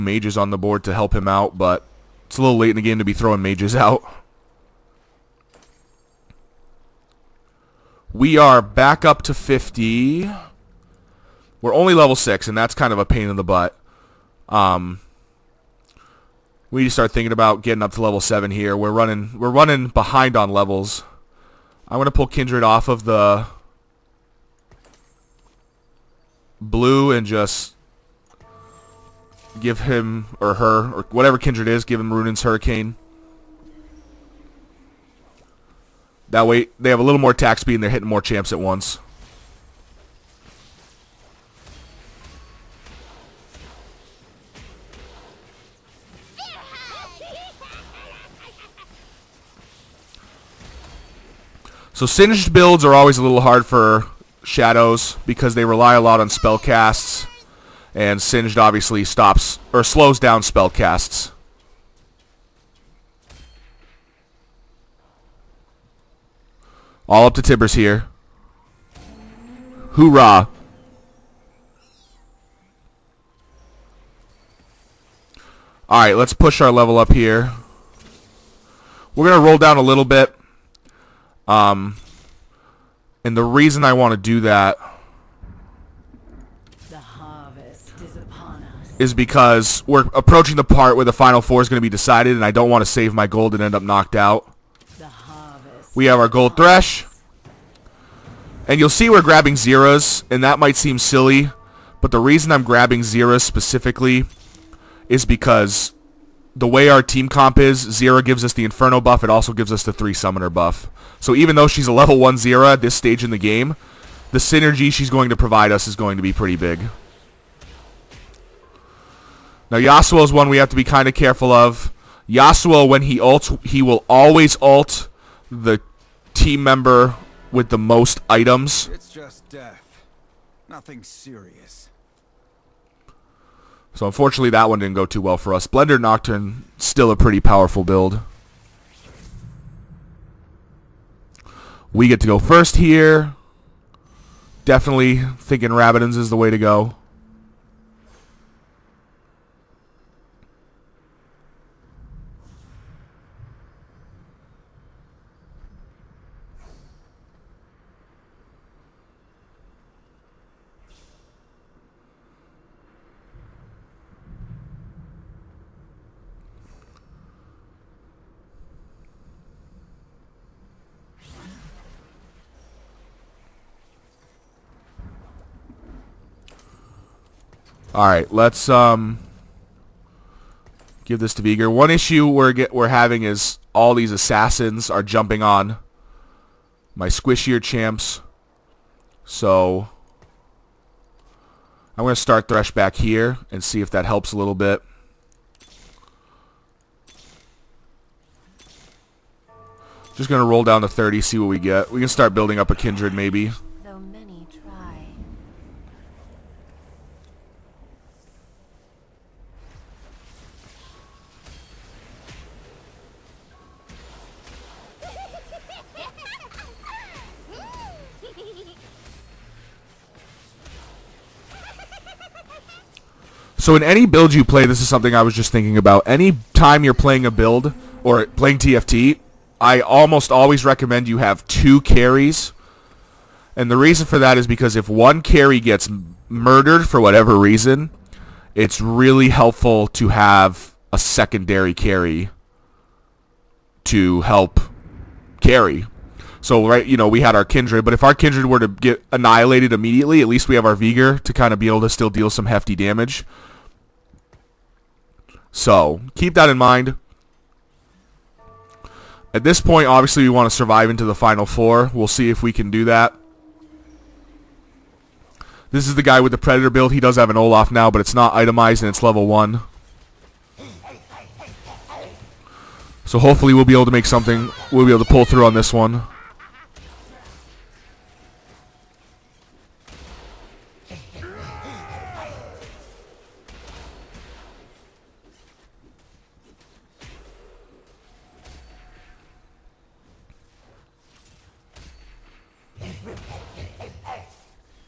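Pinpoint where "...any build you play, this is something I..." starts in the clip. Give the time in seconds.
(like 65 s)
223 s.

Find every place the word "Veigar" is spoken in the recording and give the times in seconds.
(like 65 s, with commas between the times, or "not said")
181 s, 250 s.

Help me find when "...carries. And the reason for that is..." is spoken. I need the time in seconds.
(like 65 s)
231 s.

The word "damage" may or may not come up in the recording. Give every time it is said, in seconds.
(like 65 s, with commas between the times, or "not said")
252 s.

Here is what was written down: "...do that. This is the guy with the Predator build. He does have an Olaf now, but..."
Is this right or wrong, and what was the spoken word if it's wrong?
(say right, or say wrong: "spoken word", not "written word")
right.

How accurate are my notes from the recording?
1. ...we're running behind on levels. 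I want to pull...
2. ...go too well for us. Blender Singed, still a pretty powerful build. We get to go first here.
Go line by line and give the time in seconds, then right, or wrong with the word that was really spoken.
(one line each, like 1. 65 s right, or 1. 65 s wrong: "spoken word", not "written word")
1. 19 s right
2. 134 s wrong: "Nocturne", not "Singed".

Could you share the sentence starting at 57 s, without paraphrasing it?
And Singed obviously stops or slows down spell casts.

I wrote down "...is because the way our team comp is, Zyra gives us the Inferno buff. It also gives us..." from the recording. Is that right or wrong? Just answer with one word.
right.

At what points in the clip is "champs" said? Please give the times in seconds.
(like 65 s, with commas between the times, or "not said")
38 s, 187 s.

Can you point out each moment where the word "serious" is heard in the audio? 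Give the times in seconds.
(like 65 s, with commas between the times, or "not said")
131 s.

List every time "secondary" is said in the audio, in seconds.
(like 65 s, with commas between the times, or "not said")
240 s.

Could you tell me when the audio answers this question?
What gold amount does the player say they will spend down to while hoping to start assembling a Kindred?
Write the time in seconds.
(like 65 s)
200 s.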